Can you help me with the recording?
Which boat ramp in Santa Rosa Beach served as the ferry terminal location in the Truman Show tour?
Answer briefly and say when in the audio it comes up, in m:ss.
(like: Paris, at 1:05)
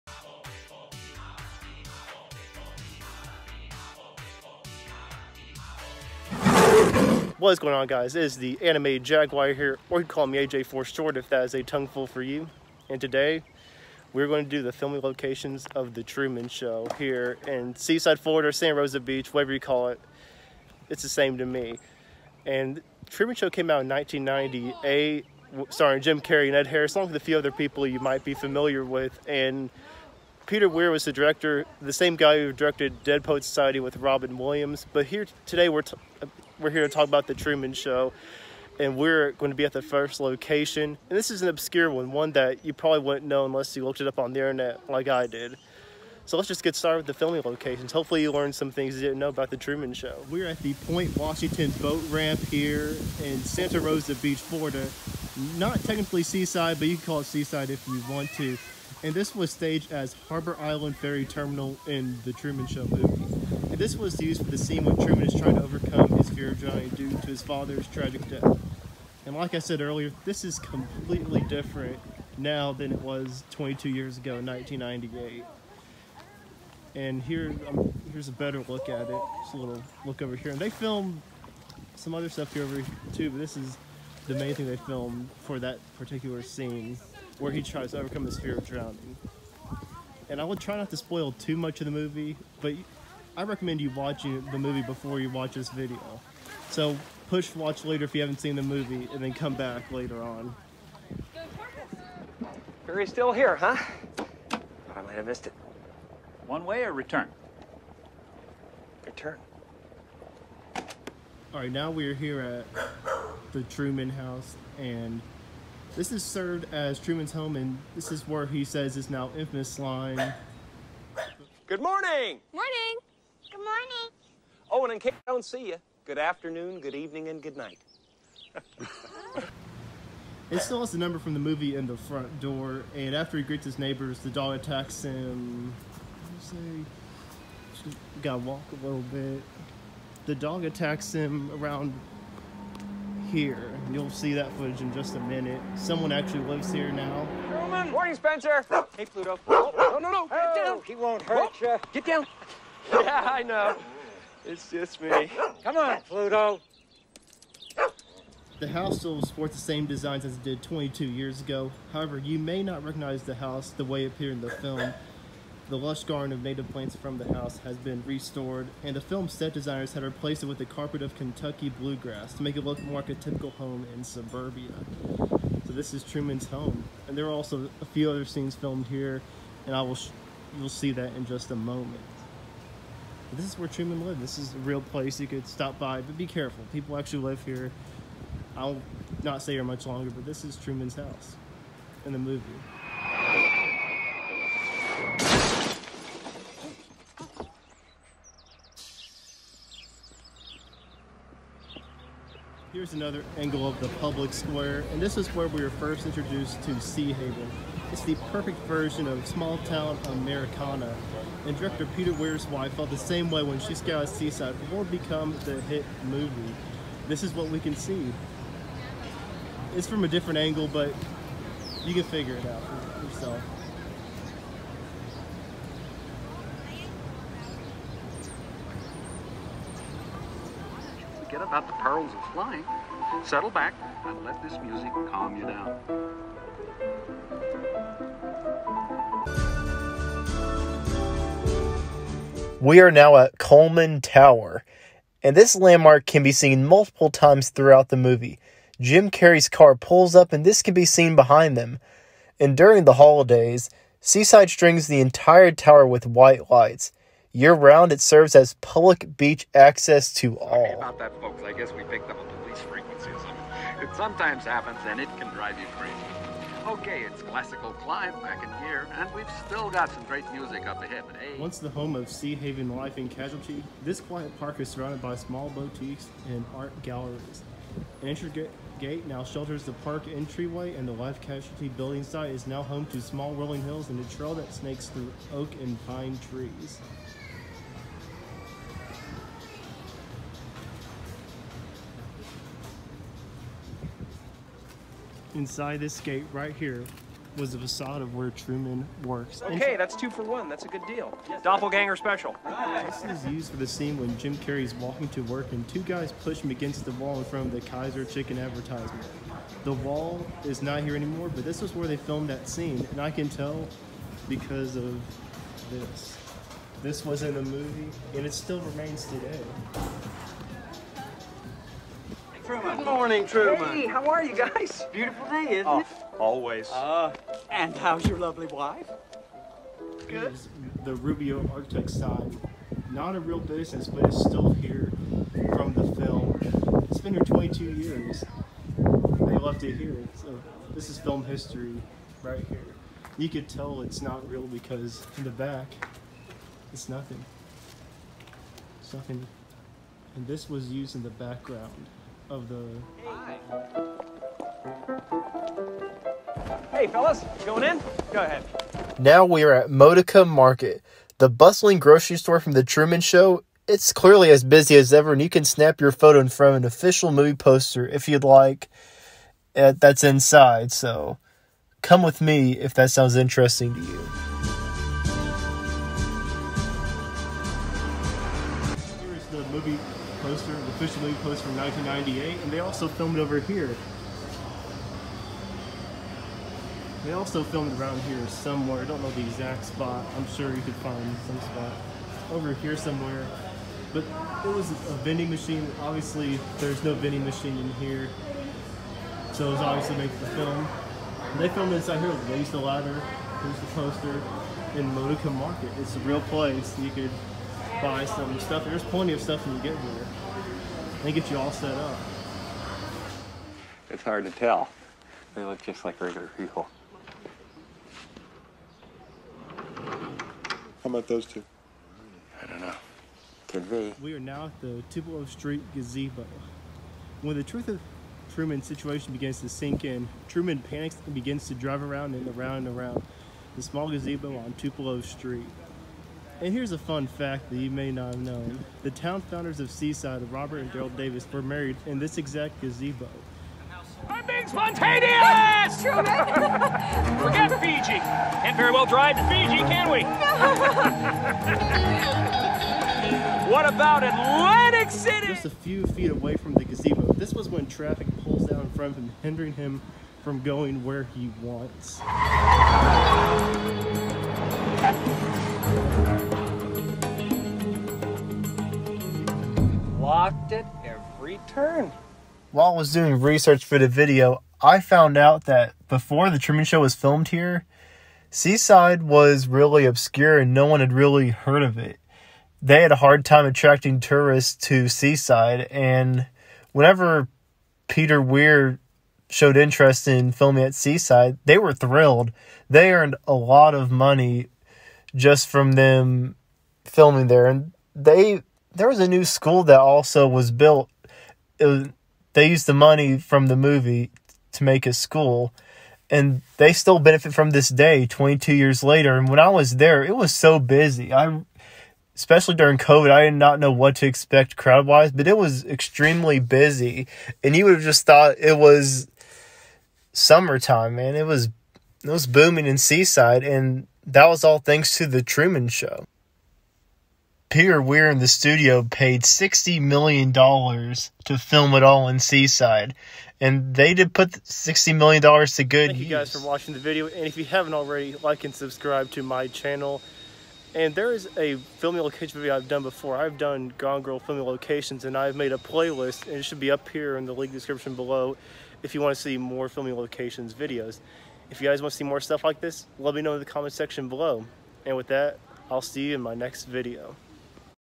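Point Washington boat ramp, at 0:50.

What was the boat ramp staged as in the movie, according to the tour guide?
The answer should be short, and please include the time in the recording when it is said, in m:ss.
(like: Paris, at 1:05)
Harbor Island Ferry Terminal, at 1:00.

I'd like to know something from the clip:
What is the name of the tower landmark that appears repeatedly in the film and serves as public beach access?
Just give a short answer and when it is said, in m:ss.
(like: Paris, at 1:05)
Coleman Tower, at 4:03.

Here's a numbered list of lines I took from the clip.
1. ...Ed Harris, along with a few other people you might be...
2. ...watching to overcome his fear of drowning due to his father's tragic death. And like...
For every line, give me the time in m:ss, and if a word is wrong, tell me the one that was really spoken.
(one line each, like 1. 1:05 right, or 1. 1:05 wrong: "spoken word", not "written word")
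1. 0:26 right
2. 1:05 wrong: "trying", not "watching".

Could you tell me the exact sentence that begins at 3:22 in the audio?
Here's another angle of the public square, and this is where we were first introduced to Sea Haven.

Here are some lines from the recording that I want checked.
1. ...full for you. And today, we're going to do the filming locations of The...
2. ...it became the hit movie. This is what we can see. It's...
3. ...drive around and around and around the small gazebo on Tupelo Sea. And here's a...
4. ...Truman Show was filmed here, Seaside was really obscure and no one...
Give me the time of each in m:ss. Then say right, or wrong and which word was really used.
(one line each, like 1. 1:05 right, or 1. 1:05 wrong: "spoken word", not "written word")
1. 0:11 right
2. 3:34 right
3. 7:11 wrong: "Street", not "Sea"
4. 7:56 right.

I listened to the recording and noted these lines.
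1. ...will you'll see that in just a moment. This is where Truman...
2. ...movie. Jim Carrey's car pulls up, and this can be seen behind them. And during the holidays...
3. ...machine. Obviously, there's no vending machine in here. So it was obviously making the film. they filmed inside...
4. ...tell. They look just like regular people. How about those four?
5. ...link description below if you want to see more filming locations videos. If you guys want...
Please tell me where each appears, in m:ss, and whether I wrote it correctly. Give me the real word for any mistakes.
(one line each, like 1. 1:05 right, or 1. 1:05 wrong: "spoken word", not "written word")
1. 2:59 right
2. 4:07 right
3. 6:35 right
4. 6:54 wrong: "two", not "four"
5. 9:07 right.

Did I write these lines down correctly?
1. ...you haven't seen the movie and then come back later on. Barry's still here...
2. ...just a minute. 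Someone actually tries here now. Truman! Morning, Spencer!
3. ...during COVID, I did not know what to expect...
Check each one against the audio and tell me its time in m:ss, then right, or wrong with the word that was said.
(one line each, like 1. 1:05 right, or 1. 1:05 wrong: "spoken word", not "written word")
1. 1:38 right
2. 2:24 wrong: "lives", not "tries"
3. 8:32 right.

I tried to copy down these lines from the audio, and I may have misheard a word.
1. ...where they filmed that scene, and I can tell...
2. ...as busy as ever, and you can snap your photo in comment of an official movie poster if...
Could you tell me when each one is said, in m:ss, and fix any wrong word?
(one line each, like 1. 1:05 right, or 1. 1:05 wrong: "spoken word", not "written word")
1. 5:11 right
2. 6:04 wrong: "front", not "comment".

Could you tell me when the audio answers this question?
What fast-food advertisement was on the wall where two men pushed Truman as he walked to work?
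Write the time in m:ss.
5:07.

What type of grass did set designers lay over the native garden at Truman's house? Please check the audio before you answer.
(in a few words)
Kentucky bluegrass.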